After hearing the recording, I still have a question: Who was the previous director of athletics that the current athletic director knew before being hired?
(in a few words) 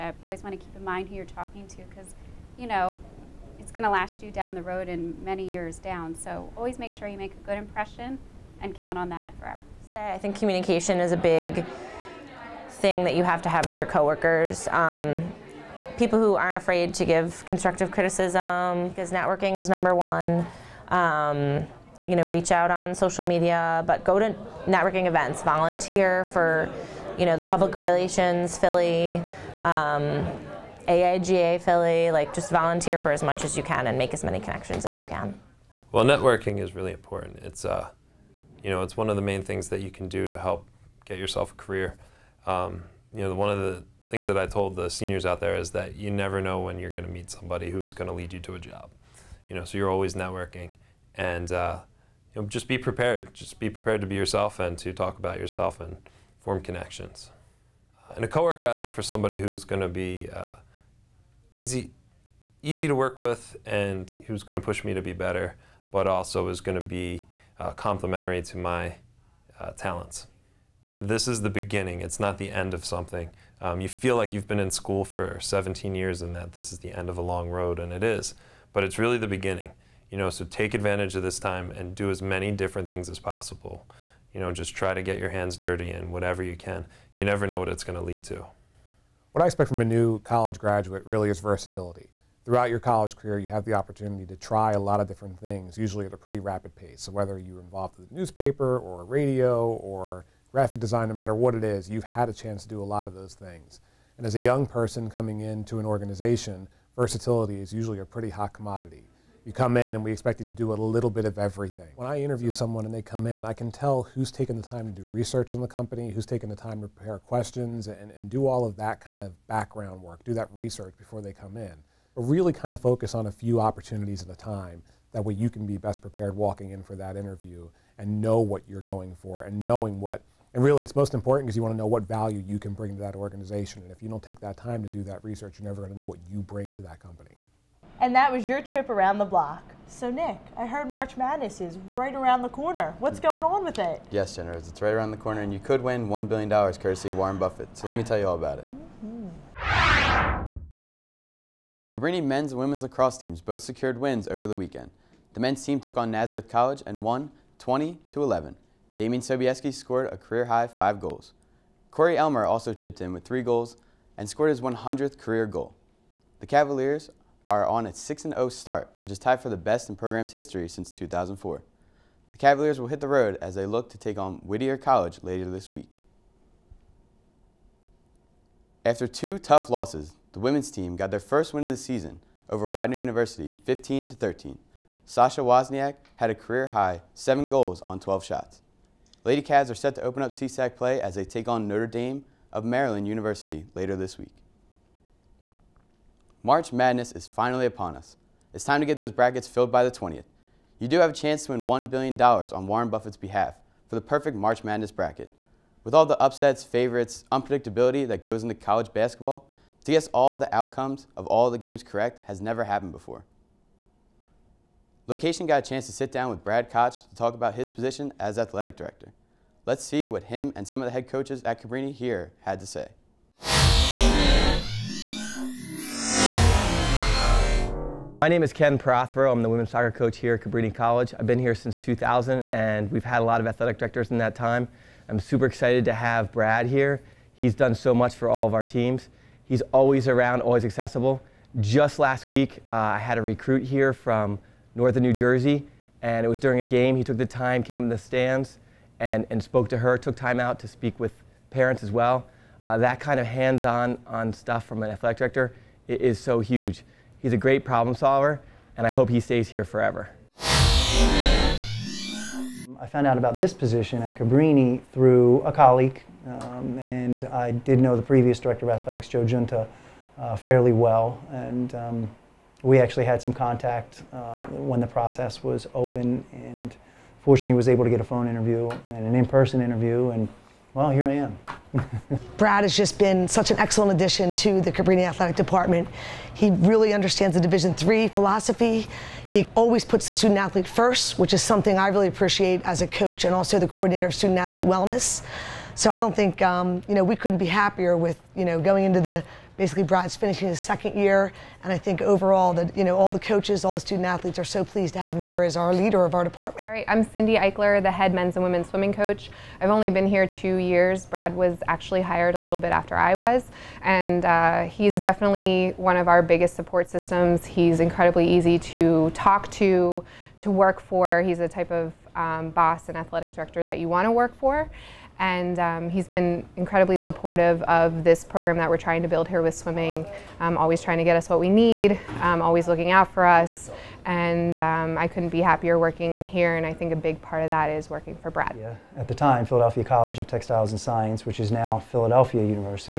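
Joe Junta.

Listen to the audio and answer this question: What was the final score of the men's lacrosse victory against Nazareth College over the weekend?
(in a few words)
20 to 11.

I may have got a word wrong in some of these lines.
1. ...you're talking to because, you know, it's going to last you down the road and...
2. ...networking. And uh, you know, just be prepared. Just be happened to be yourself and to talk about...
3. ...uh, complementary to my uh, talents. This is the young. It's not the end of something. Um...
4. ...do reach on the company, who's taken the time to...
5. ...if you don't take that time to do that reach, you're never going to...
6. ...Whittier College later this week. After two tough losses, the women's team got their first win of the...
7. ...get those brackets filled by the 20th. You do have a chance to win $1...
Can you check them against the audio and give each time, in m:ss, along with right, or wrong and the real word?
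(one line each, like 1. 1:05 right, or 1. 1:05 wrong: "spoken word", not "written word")
1. 0:01 right
2. 0:50 wrong: "prepared", not "happened"
3. 1:07 wrong: "beginning", not "young"
4. 1:55 wrong: "research", not "reach"
5. 2:13 wrong: "research", not "reach"
6. 2:54 right
7. 3:18 right.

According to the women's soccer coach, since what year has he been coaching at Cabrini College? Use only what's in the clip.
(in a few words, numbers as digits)
2000.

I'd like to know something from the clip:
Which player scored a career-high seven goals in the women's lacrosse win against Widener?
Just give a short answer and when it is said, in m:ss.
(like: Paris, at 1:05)
Sasha Wozniak, at 3:05.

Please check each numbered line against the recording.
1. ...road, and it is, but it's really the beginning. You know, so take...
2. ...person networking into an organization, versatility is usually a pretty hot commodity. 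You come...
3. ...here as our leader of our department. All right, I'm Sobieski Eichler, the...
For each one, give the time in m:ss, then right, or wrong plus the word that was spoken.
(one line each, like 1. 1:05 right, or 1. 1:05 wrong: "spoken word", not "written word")
1. 1:17 right
2. 1:44 wrong: "coming", not "networking"
3. 5:05 wrong: "Cindy", not "Sobieski".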